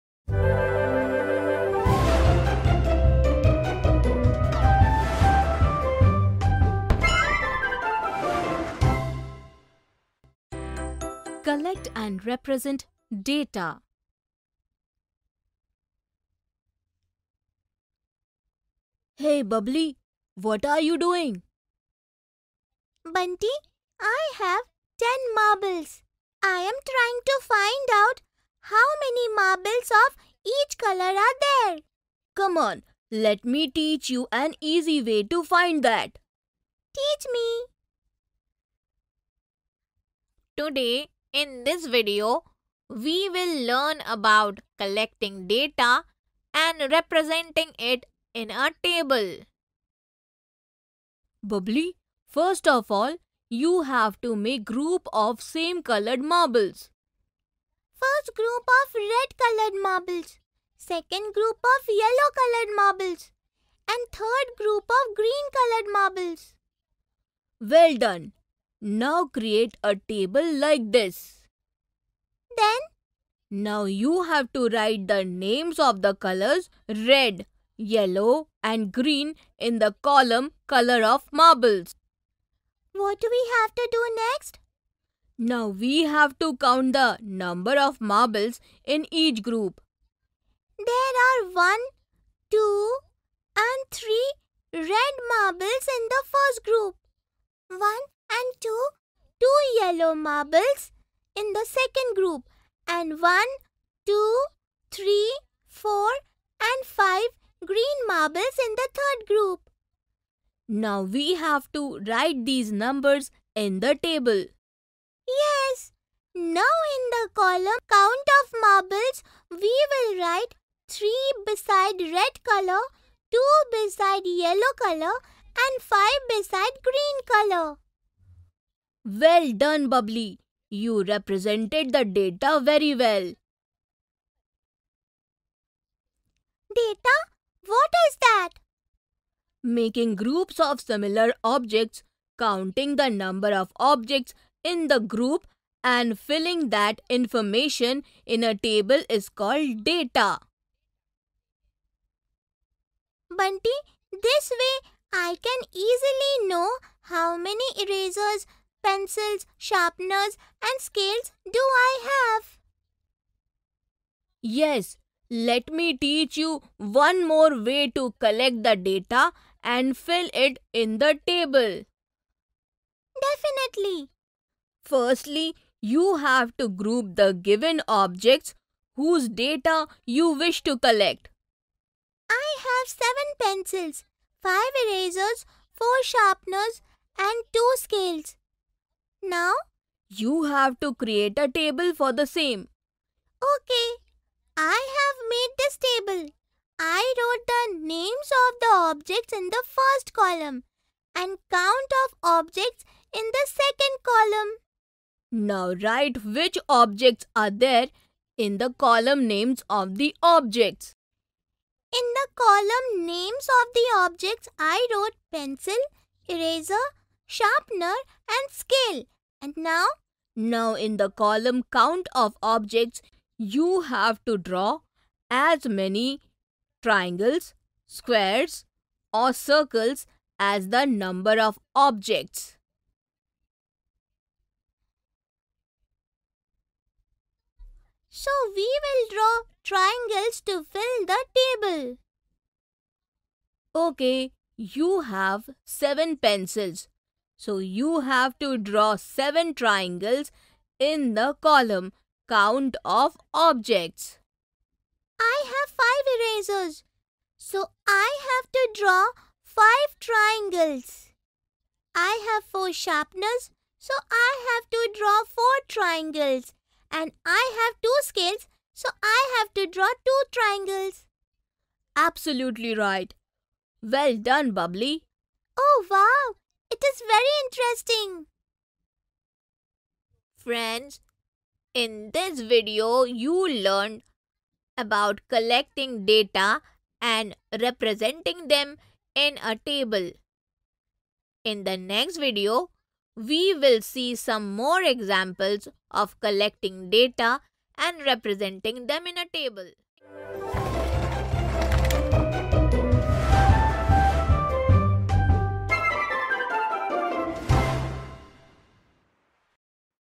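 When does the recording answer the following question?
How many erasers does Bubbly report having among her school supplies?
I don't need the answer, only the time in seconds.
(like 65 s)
184 s.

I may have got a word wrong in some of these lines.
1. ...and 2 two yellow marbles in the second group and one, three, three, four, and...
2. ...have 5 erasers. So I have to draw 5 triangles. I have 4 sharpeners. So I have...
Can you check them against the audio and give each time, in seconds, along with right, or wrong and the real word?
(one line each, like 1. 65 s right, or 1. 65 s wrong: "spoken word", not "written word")
1. 98 s wrong: "two", not "three"
2. 255 s right.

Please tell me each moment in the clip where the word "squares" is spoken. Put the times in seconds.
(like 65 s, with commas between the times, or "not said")
227 s.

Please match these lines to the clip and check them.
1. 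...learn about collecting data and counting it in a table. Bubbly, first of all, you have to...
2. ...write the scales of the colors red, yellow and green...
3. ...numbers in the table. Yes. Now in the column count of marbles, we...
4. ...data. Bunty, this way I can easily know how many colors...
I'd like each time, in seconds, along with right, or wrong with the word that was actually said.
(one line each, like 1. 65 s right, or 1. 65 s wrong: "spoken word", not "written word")
1. 43 s wrong: "representing", not "counting"
2. 74 s wrong: "names", not "scales"
3. 112 s right
4. 149 s wrong: "erasers", not "colors".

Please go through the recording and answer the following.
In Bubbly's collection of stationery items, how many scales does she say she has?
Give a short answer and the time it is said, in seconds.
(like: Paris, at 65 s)
2, at 187 s.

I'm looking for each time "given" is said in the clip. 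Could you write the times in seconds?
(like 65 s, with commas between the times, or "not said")
177 s.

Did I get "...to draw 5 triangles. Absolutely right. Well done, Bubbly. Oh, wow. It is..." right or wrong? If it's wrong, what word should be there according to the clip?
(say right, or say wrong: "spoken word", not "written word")
wrong: "2", not "5".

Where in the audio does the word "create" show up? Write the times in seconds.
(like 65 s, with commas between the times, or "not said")
69 s, 190 s.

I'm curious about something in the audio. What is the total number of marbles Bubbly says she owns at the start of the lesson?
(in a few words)
10.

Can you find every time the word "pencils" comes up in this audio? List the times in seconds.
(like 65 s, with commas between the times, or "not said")
158 s, 183 s, 215 s, 246 s.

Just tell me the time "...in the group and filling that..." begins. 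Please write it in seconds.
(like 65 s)
144 s.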